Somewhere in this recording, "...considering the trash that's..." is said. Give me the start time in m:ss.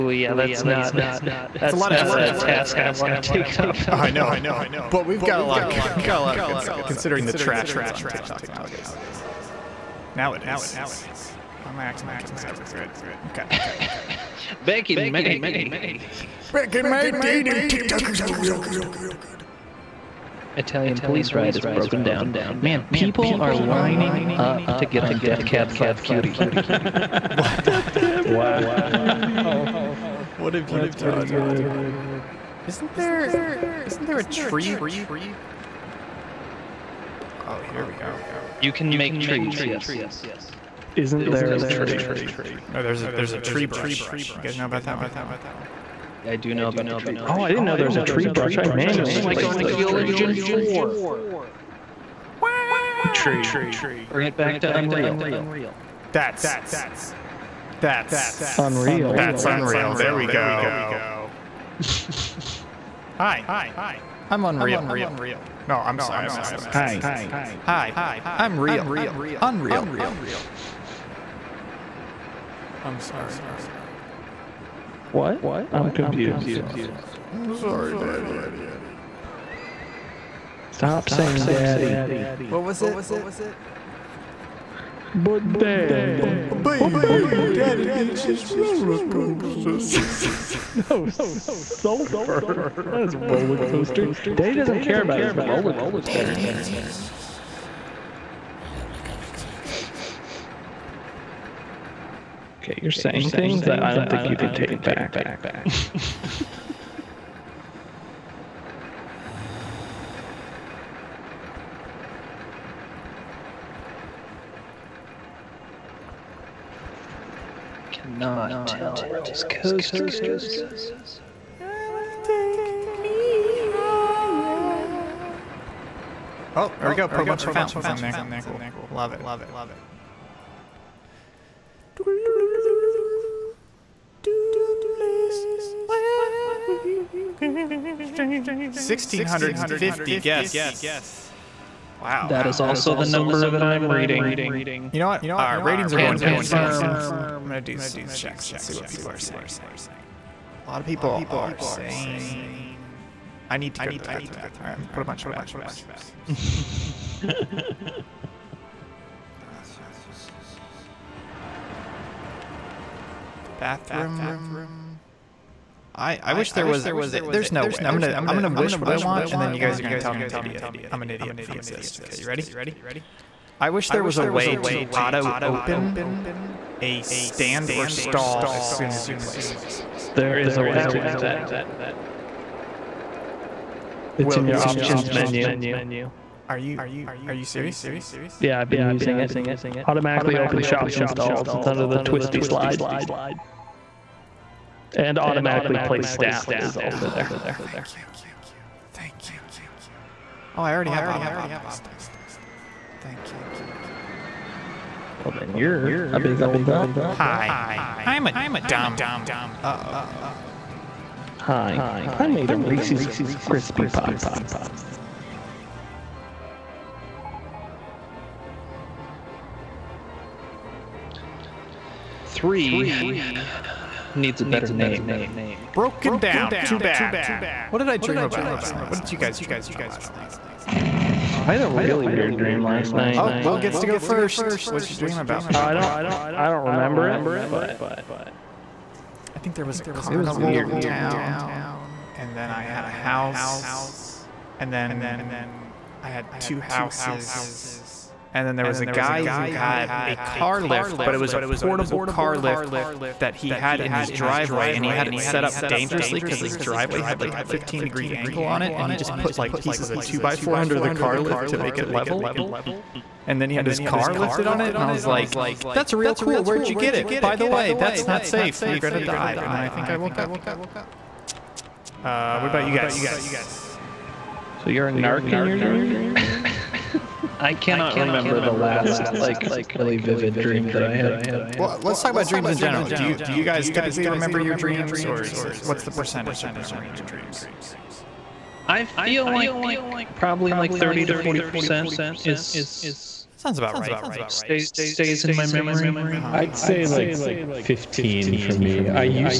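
0:06.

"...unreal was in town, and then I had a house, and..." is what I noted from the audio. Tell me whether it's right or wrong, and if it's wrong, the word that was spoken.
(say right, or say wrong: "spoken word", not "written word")
wrong: "carnival", not "unreal".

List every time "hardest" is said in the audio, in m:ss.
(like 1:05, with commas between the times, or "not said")
not said.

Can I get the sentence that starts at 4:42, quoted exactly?
Do you do you guys typically remember your dreams, or is it what's the percentage of remembering your dreams?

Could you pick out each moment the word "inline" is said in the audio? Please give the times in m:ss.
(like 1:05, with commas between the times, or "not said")
not said.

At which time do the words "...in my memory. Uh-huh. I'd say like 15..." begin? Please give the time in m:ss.
4:55.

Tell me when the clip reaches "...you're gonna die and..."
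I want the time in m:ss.
4:28.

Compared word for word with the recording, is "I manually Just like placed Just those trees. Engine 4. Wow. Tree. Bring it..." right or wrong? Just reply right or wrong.
wrong.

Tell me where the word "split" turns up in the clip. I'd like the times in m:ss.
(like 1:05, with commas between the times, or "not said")
not said.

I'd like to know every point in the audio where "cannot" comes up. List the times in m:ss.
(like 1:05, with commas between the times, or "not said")
1:57, 4:37.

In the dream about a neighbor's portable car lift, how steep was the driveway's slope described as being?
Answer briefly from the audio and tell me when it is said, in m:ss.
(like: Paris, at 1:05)
15 degrees, at 4:17.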